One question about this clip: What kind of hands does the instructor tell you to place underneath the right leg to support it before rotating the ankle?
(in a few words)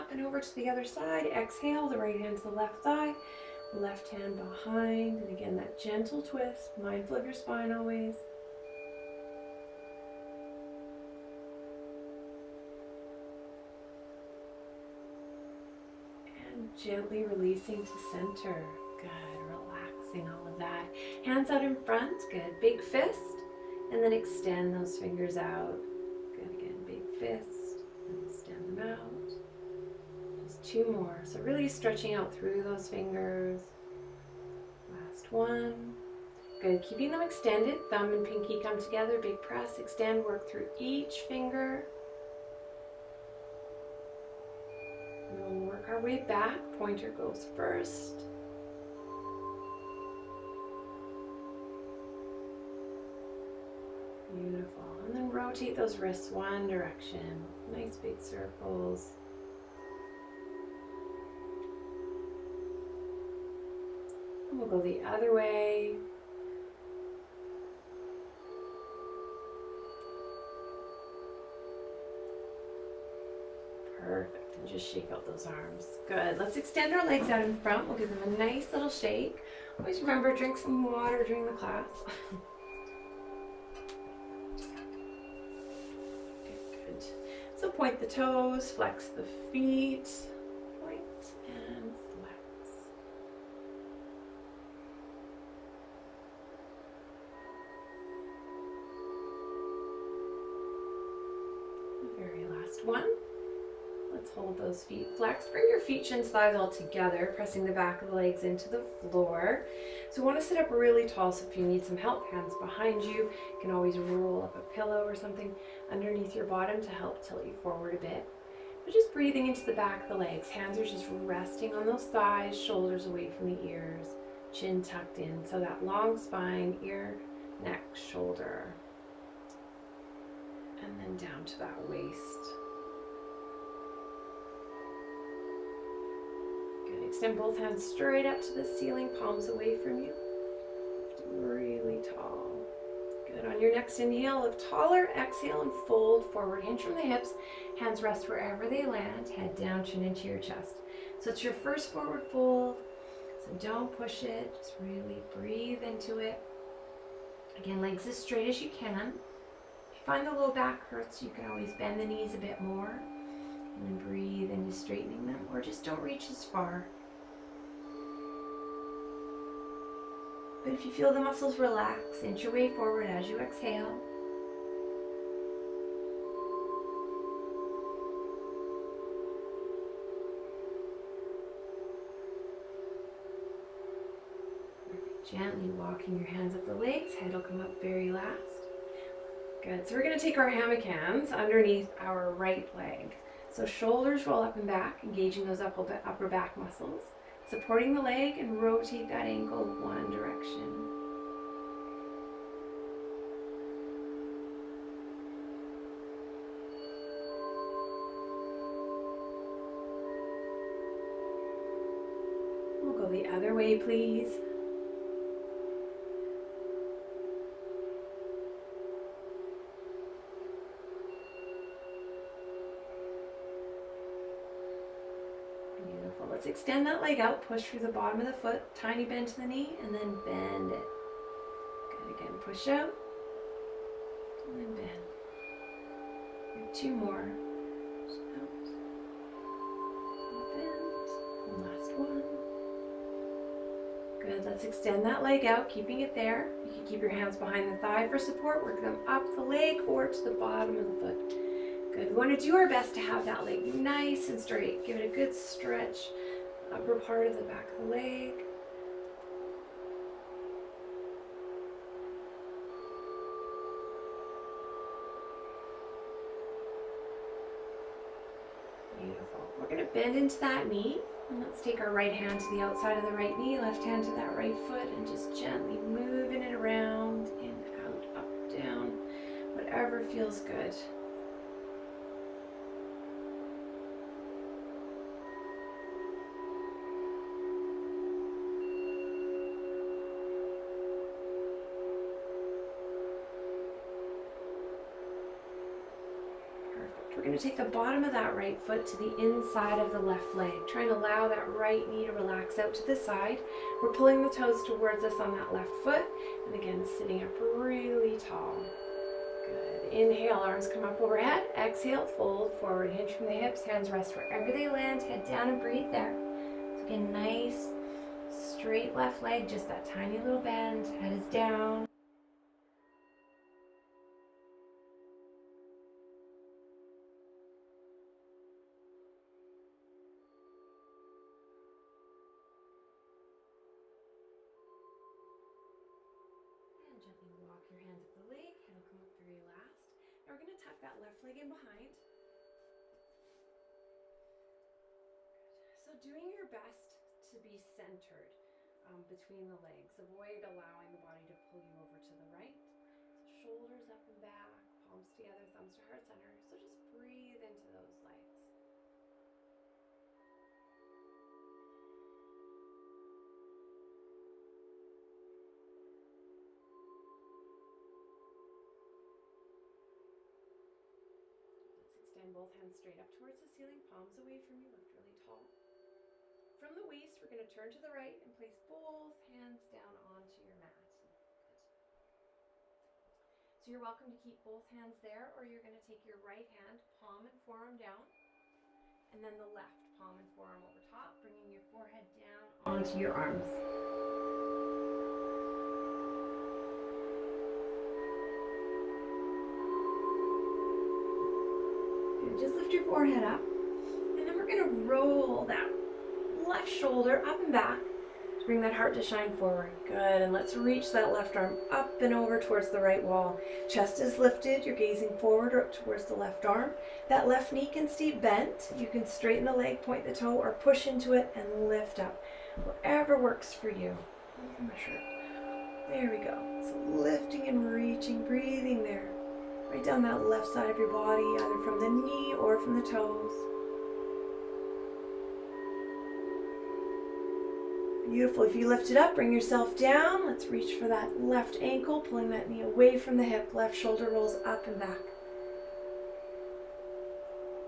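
Hammock hands.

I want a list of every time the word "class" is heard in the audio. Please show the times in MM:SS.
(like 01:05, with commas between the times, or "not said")
01:21.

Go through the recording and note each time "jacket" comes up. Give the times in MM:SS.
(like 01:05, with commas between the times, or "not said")
not said.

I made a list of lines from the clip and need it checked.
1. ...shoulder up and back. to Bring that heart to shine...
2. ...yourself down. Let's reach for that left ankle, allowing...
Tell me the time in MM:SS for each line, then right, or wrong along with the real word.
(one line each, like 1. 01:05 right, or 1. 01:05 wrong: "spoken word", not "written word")
1. 06:46 right
2. 07:19 wrong: "pulling", not "allowing".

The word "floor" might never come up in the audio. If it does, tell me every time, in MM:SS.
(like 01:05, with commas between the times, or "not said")
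01:49.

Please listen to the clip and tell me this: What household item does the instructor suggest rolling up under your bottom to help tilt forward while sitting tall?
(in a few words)
A pillow.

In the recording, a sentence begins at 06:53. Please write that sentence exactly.
Chest is lifted, you're gazing forward or up towards the left arm.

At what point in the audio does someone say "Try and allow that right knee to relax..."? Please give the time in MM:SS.
05:00.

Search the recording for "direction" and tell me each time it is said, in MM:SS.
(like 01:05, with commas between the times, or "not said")
00:56, 03:20.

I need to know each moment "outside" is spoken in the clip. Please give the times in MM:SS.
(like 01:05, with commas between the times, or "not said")
04:32.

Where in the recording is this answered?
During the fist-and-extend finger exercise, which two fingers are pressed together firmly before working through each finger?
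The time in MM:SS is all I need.
00:37.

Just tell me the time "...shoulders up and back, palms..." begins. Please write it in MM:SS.
05:53.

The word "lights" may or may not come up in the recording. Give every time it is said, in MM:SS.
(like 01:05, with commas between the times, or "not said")
05:58.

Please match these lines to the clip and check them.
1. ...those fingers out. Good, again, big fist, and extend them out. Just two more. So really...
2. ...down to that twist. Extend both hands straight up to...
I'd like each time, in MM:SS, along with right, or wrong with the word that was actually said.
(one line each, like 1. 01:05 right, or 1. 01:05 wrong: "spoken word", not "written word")
1. 00:24 right
2. 02:11 wrong: "waist", not "twist".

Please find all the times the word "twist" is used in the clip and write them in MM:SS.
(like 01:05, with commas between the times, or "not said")
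00:06.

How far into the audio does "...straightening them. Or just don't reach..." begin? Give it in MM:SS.
02:44.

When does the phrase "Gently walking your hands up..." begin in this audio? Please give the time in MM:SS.
03:05.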